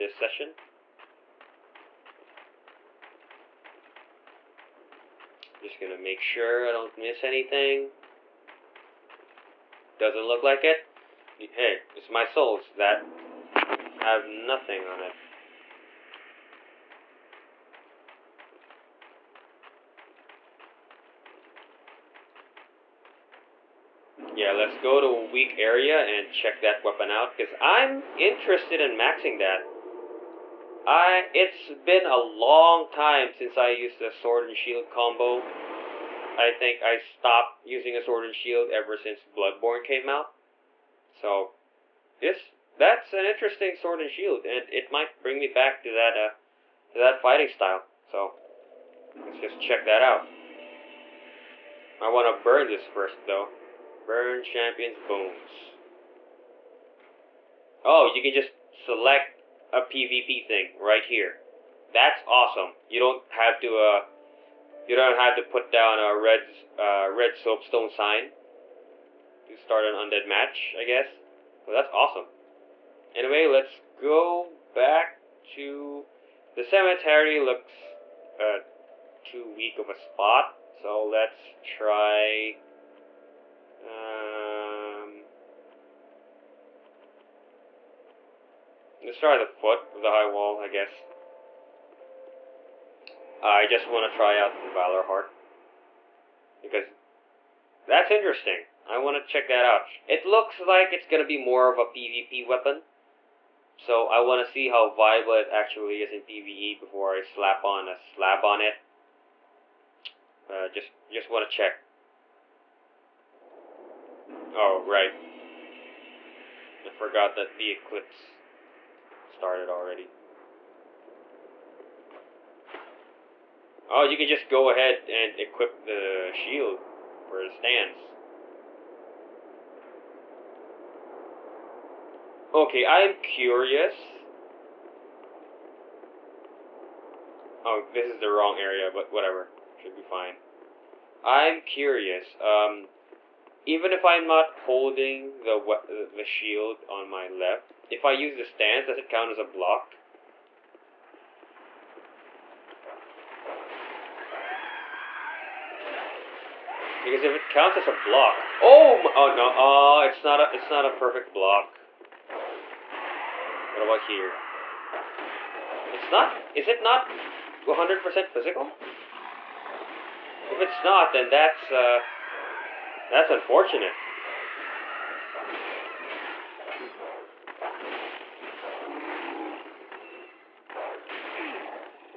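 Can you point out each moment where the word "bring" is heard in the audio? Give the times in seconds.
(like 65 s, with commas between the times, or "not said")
45 s.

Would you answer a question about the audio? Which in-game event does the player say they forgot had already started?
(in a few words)
The eclipse.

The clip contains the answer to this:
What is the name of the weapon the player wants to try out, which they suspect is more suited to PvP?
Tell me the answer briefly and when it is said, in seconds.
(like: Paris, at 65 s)
Valor Heart, at 94 s.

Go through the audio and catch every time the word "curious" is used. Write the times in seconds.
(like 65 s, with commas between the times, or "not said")
133 s, 141 s.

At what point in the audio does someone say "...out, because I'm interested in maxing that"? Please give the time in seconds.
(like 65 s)
27 s.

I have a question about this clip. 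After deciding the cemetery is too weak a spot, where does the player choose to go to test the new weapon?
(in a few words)
The foot of the high wall.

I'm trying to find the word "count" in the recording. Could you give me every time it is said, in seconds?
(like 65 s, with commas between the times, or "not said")
149 s, 157 s.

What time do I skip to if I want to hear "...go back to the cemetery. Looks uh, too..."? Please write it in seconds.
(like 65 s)
73 s.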